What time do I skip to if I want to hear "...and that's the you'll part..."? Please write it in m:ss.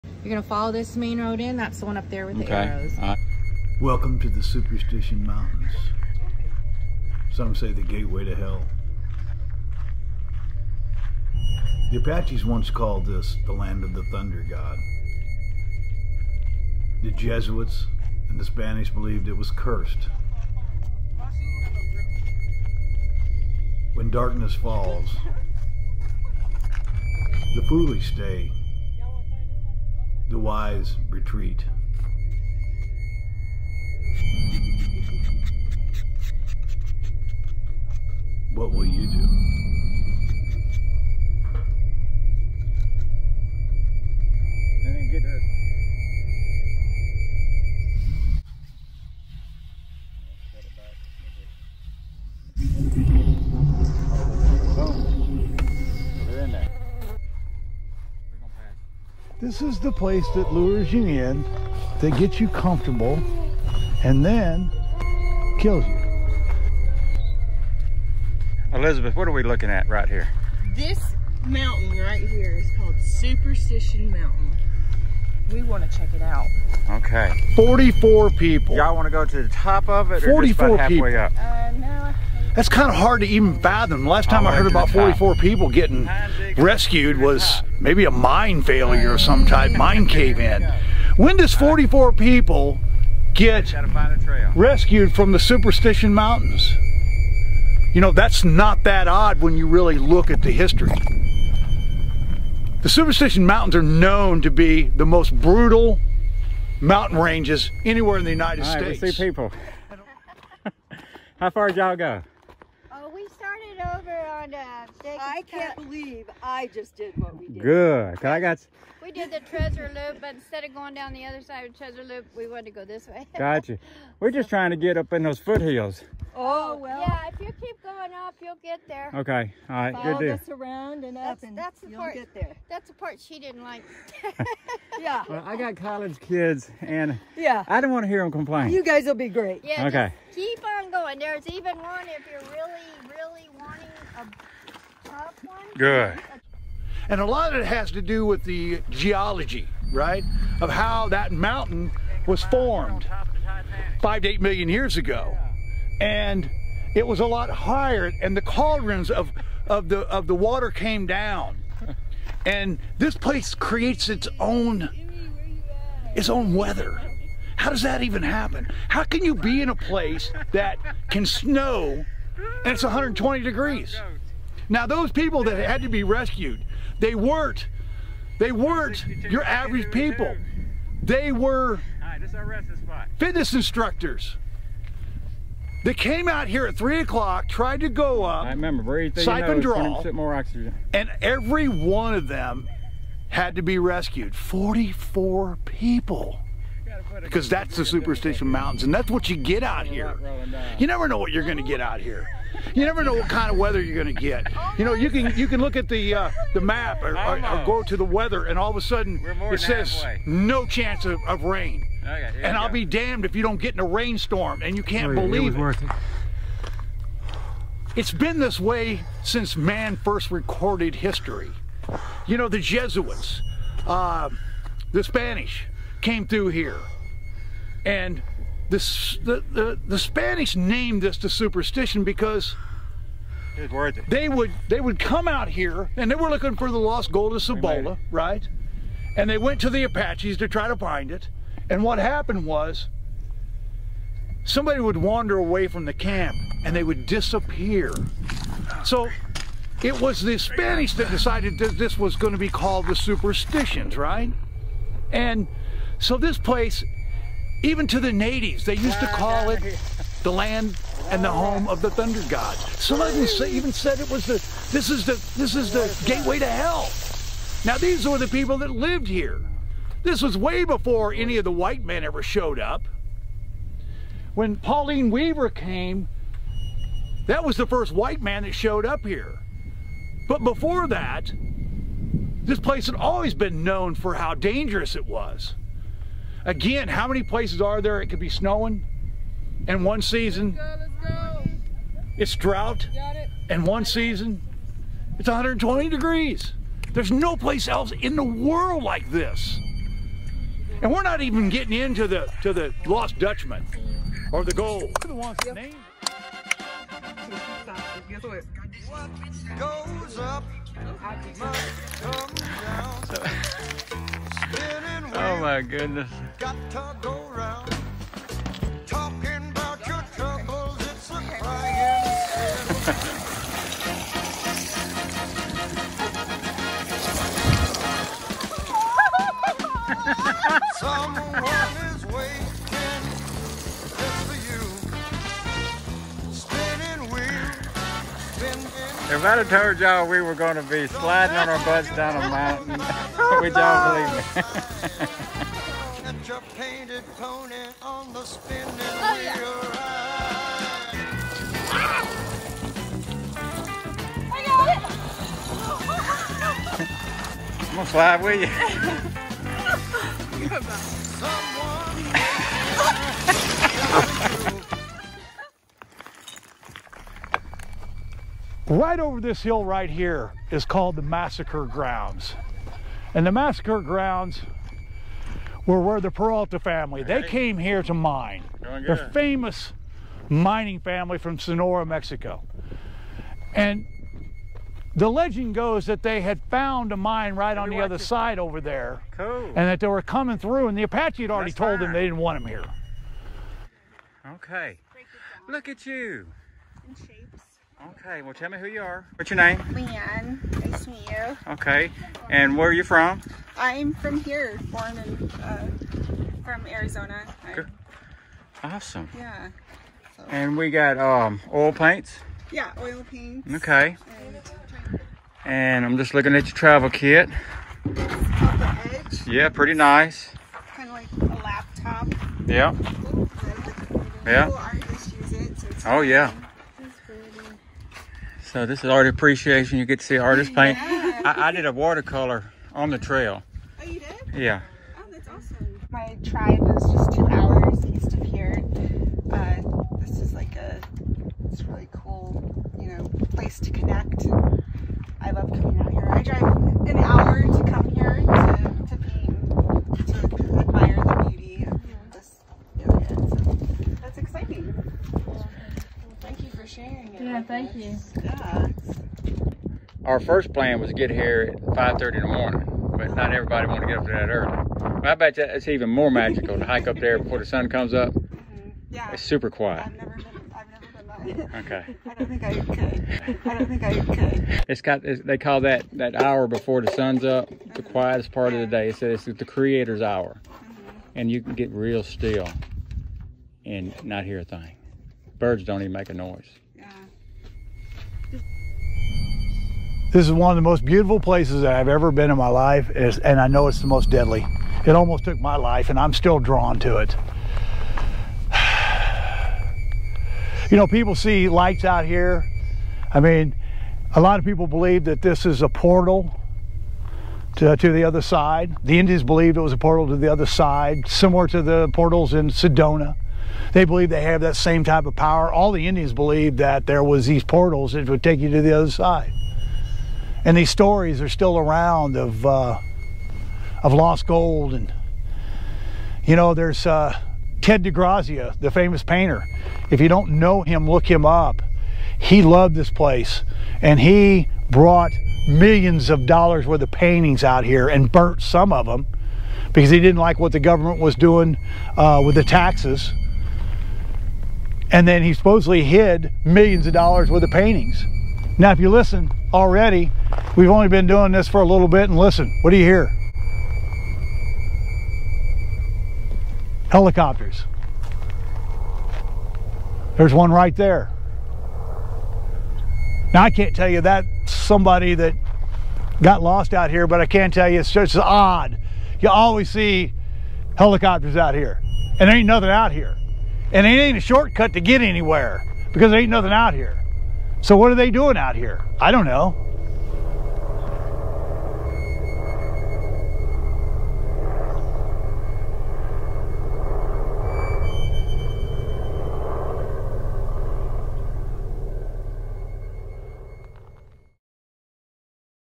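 2:11.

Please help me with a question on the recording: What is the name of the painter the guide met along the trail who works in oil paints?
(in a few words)
Leanne.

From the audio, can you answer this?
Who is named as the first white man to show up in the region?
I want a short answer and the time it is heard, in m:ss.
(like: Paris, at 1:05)
Pauline Weaver, at 4:34.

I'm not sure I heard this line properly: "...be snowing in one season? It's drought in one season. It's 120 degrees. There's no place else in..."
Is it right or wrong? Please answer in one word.
right.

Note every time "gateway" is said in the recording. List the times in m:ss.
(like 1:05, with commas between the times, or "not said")
0:07, 4:26.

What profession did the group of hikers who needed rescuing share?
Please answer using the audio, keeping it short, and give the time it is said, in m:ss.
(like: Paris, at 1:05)
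fitness instructors, at 3:03.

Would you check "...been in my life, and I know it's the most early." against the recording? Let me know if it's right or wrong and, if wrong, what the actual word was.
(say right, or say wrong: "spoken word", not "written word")
wrong: "deadly", not "early".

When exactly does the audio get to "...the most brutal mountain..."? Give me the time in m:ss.
1:44.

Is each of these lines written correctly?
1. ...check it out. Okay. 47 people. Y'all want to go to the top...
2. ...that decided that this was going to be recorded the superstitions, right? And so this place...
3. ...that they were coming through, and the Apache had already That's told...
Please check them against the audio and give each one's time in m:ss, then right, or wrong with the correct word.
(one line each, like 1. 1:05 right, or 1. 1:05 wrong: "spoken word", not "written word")
1. 1:15 wrong: "44", not "47"
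2. 4:10 wrong: "called", not "recorded"
3. 6:29 right.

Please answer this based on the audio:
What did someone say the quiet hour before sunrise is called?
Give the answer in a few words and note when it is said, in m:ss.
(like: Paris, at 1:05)
the creator's hour, at 7:59.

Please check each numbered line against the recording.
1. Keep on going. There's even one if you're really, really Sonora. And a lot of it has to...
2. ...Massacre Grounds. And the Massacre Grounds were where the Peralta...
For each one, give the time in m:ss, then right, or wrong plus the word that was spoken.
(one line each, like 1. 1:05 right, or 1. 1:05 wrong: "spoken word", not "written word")
1. 2:20 wrong: "Good", not "Sonora"
2. 6:11 right.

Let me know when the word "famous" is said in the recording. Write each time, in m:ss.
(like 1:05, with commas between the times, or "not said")
6:19, 8:48.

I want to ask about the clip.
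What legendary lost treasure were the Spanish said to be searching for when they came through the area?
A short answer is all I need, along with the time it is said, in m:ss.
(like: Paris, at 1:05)
gold of Cibola, at 3:56.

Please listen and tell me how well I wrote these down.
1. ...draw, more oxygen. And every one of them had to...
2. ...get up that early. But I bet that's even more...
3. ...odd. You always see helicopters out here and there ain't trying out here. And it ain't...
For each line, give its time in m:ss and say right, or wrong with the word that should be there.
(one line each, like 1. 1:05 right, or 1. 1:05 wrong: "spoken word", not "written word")
1. 3:10 right
2. 7:43 right
3. 9:28 wrong: "nothing", not "trying".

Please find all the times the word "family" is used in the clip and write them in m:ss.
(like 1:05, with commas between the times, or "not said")
6:16, 6:20.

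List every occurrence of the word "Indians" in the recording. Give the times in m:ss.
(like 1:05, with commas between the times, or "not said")
8:28, 8:35.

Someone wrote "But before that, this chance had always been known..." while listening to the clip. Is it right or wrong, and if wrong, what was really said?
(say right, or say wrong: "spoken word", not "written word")
wrong: "place", not "chance".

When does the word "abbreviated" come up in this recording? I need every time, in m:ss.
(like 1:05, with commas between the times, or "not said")
not said.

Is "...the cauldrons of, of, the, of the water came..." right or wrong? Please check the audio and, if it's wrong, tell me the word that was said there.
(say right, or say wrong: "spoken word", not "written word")
right.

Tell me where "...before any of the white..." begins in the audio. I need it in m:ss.
4:30.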